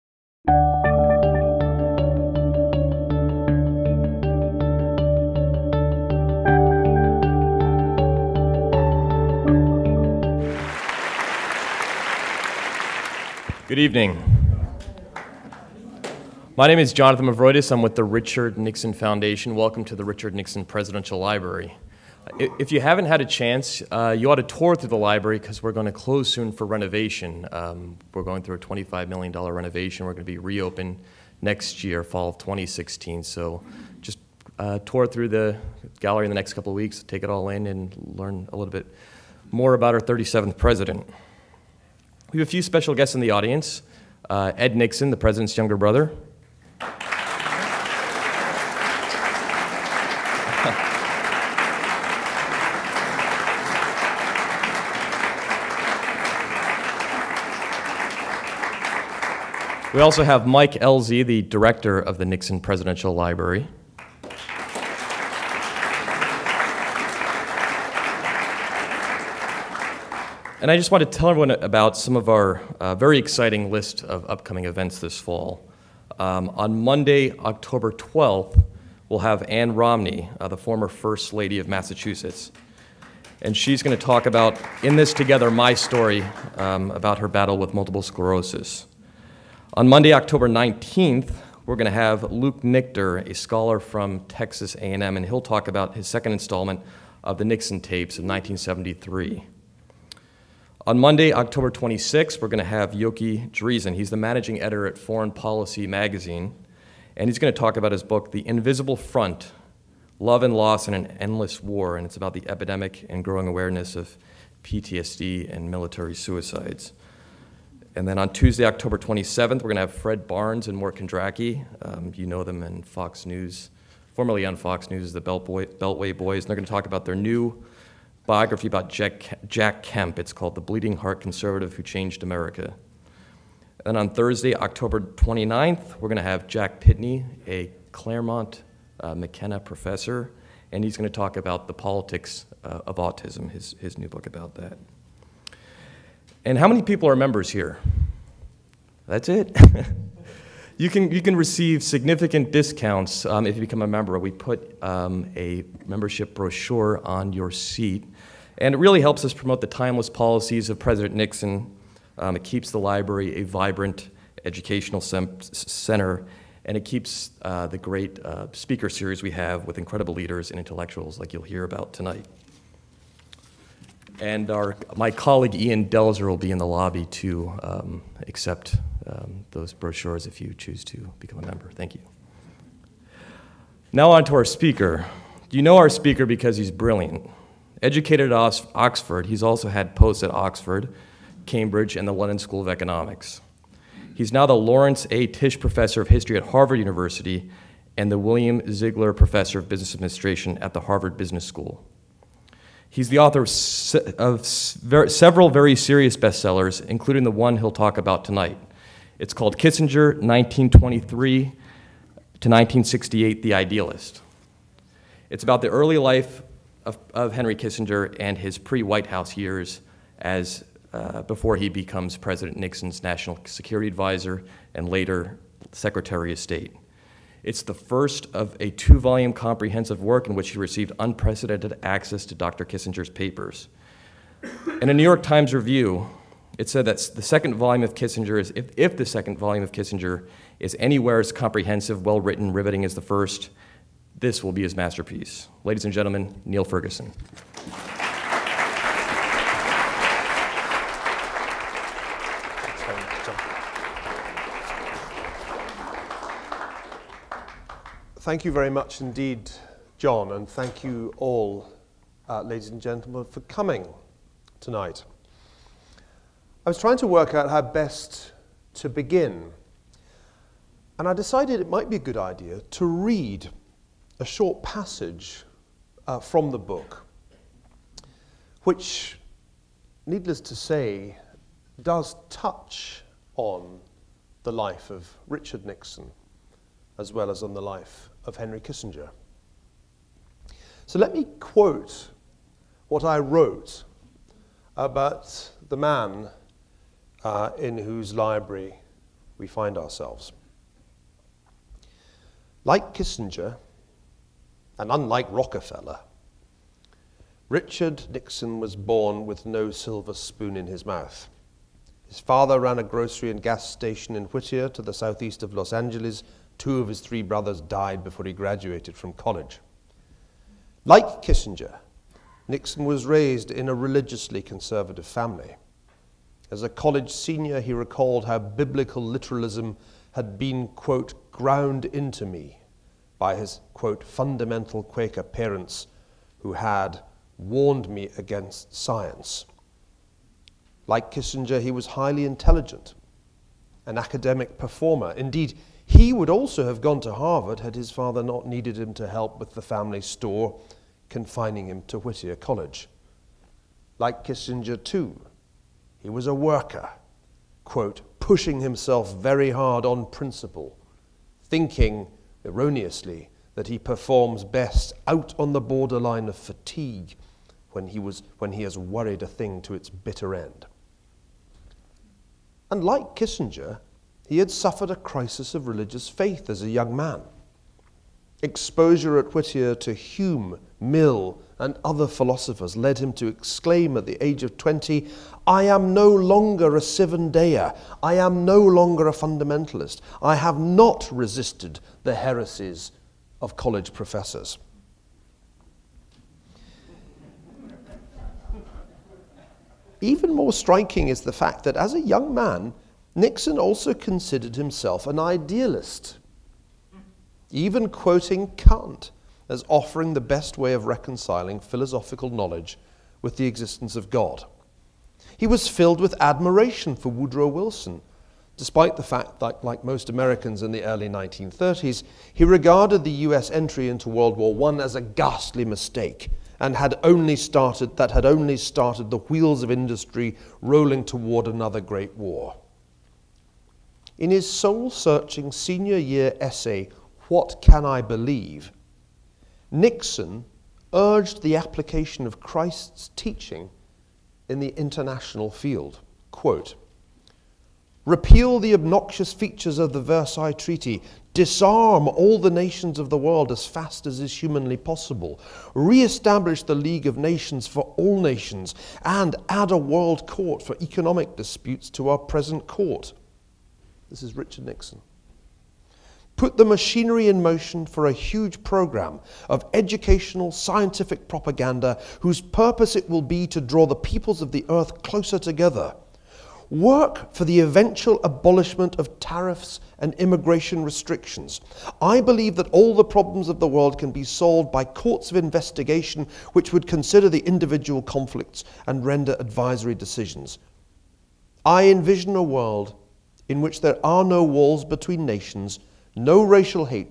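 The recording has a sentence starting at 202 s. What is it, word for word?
He's the author of, se of ver several very serious bestsellers, including the one he'll talk about tonight.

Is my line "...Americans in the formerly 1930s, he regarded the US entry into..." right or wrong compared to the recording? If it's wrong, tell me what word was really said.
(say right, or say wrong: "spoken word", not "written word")
wrong: "early", not "formerly".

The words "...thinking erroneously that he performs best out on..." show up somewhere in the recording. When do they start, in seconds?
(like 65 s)
361 s.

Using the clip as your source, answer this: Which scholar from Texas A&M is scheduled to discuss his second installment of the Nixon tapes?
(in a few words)
Luke Nichter.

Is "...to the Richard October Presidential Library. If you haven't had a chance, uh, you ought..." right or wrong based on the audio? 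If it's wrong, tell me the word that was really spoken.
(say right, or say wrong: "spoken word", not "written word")
wrong: "Nixon", not "October".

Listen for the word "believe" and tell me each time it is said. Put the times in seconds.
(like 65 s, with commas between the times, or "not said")
438 s, 482 s.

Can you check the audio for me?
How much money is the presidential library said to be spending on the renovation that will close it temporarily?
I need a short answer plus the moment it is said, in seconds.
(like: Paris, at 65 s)
$25 million, at 28 s.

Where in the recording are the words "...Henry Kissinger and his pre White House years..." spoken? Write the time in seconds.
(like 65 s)
217 s.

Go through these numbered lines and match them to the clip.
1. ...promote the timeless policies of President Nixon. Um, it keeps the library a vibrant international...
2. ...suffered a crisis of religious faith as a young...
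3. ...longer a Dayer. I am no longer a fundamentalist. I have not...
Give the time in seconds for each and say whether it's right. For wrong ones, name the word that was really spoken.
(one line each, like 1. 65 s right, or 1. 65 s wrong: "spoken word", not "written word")
1. 159 s wrong: "educational", not "international"
2. 374 s right
3. 386 s right.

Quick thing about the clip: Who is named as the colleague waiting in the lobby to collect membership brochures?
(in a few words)
Ian Delzer.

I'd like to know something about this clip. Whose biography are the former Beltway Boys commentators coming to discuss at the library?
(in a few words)
Jack Kemp.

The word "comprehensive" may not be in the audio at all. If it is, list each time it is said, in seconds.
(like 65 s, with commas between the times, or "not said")
229 s, 241 s.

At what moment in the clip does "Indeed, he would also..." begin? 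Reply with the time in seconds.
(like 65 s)
345 s.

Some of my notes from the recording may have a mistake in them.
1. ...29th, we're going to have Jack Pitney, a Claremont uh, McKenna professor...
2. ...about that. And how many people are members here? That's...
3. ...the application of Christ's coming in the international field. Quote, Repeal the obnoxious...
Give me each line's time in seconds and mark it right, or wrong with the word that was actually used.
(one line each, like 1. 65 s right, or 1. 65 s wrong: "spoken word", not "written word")
1. 134 s right
2. 144 s right
3. 441 s wrong: "teaching", not "coming".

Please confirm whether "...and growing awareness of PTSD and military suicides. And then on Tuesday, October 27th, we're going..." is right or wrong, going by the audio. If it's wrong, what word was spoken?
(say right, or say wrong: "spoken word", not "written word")
right.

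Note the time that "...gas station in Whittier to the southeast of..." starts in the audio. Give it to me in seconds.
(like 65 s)
313 s.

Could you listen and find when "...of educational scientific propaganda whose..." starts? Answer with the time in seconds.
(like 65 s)
469 s.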